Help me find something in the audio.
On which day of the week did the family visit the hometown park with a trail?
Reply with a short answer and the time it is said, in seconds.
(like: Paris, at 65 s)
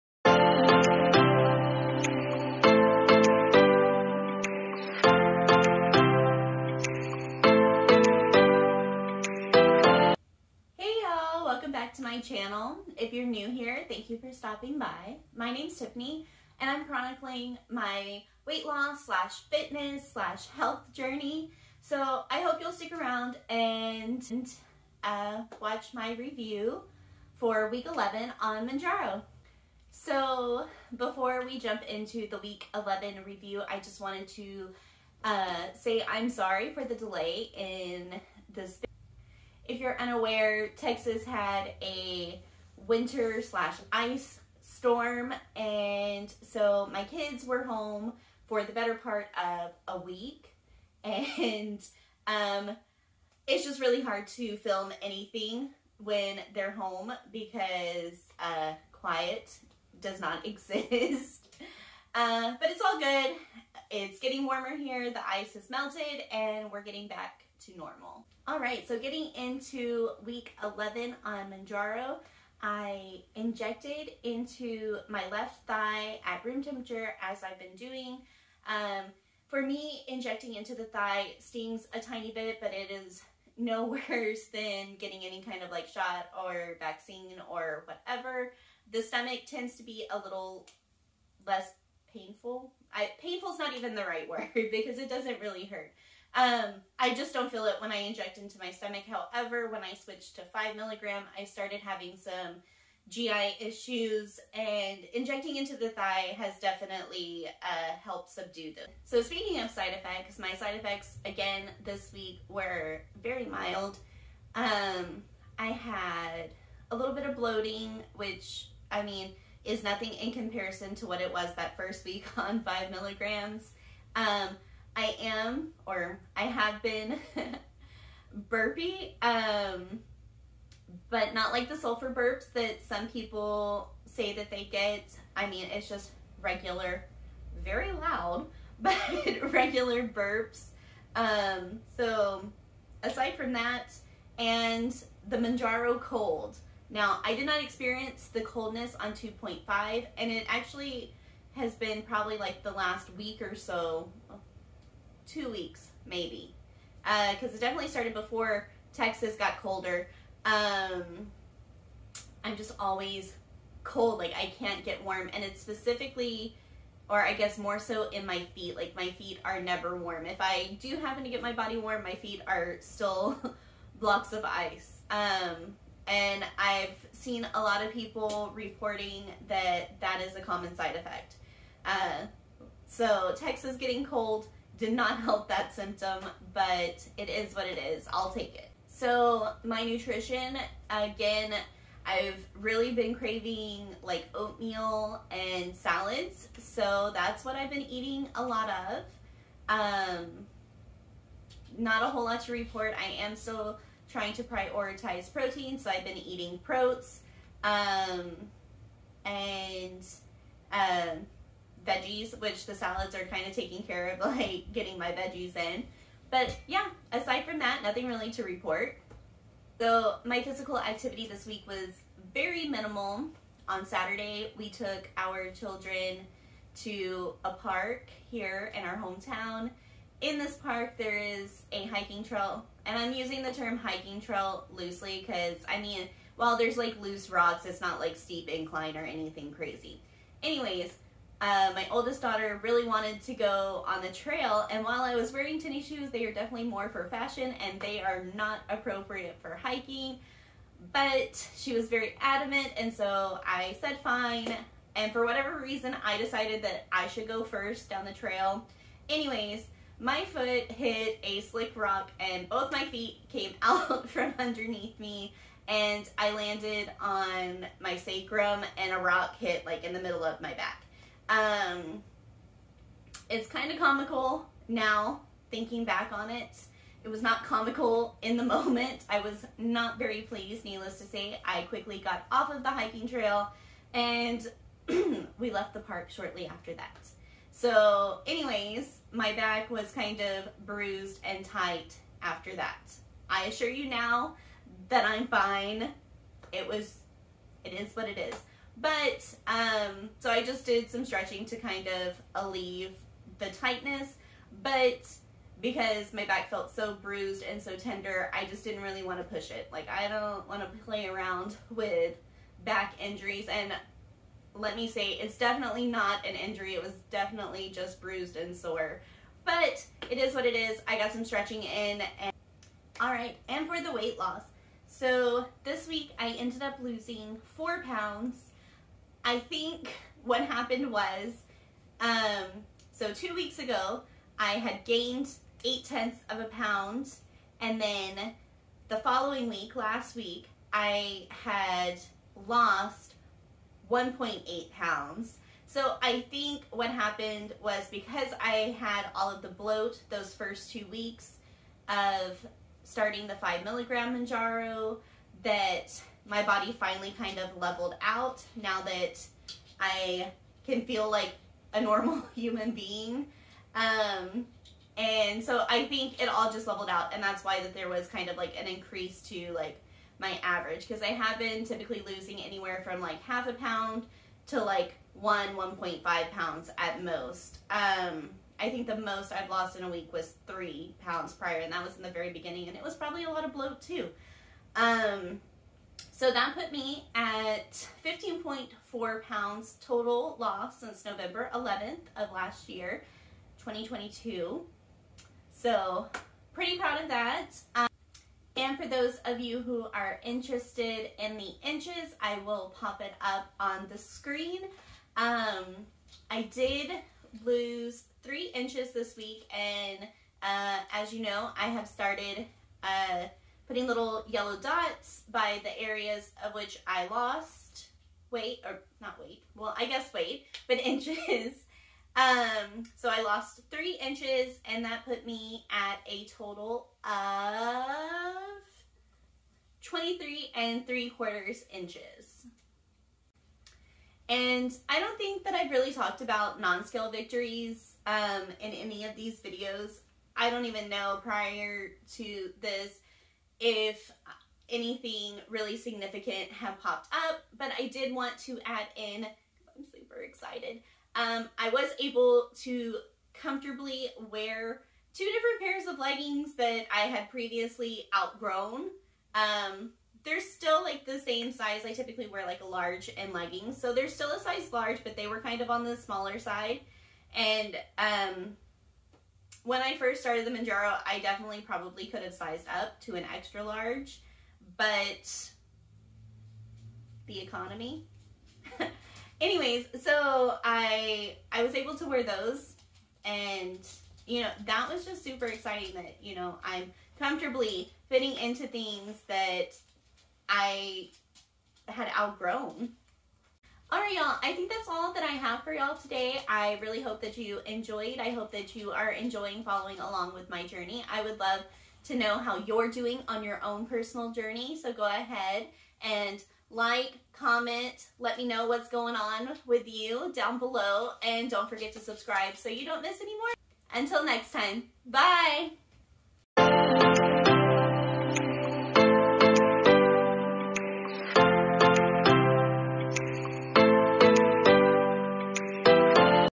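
Saturday, at 223 s.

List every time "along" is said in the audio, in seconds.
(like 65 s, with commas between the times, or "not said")
499 s.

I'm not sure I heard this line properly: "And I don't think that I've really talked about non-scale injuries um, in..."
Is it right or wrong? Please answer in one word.
wrong.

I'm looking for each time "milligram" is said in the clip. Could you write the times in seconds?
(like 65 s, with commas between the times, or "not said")
100 s, 122 s, 353 s.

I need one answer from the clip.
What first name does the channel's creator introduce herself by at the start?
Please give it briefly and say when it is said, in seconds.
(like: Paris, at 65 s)
Tiffany, at 15 s.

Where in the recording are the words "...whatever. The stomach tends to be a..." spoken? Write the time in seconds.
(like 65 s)
87 s.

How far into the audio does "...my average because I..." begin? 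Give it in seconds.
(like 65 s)
370 s.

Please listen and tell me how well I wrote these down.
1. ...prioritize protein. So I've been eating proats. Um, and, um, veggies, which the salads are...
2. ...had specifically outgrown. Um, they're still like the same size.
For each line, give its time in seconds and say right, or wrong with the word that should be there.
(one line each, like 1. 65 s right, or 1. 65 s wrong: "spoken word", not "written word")
1. 204 s right
2. 457 s wrong: "previously", not "specifically".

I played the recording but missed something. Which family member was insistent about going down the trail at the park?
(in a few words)
Oldest daughter.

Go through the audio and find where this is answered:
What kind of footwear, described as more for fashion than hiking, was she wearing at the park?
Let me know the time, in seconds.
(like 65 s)
245 s.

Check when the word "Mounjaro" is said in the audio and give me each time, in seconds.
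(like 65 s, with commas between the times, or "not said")
28 s, 71 s, 145 s, 354 s, 470 s.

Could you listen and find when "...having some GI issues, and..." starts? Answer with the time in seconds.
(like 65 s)
101 s.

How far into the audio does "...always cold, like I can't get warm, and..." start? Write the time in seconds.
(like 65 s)
162 s.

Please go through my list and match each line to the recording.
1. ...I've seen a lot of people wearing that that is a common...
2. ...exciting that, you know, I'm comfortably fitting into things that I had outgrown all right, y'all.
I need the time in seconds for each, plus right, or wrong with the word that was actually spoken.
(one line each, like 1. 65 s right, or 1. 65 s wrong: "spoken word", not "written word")
1. 176 s wrong: "reporting", not "wearing"
2. 485 s right.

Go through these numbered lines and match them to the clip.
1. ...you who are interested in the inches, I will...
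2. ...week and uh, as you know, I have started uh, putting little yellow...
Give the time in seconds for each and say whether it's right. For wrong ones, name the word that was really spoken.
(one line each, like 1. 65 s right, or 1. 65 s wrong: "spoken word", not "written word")
1. 399 s right
2. 409 s right.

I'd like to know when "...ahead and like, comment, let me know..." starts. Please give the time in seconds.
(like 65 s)
505 s.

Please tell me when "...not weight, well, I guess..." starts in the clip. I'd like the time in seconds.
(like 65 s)
418 s.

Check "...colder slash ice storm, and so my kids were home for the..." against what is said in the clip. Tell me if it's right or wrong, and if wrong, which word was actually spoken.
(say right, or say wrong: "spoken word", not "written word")
wrong: "winter", not "colder".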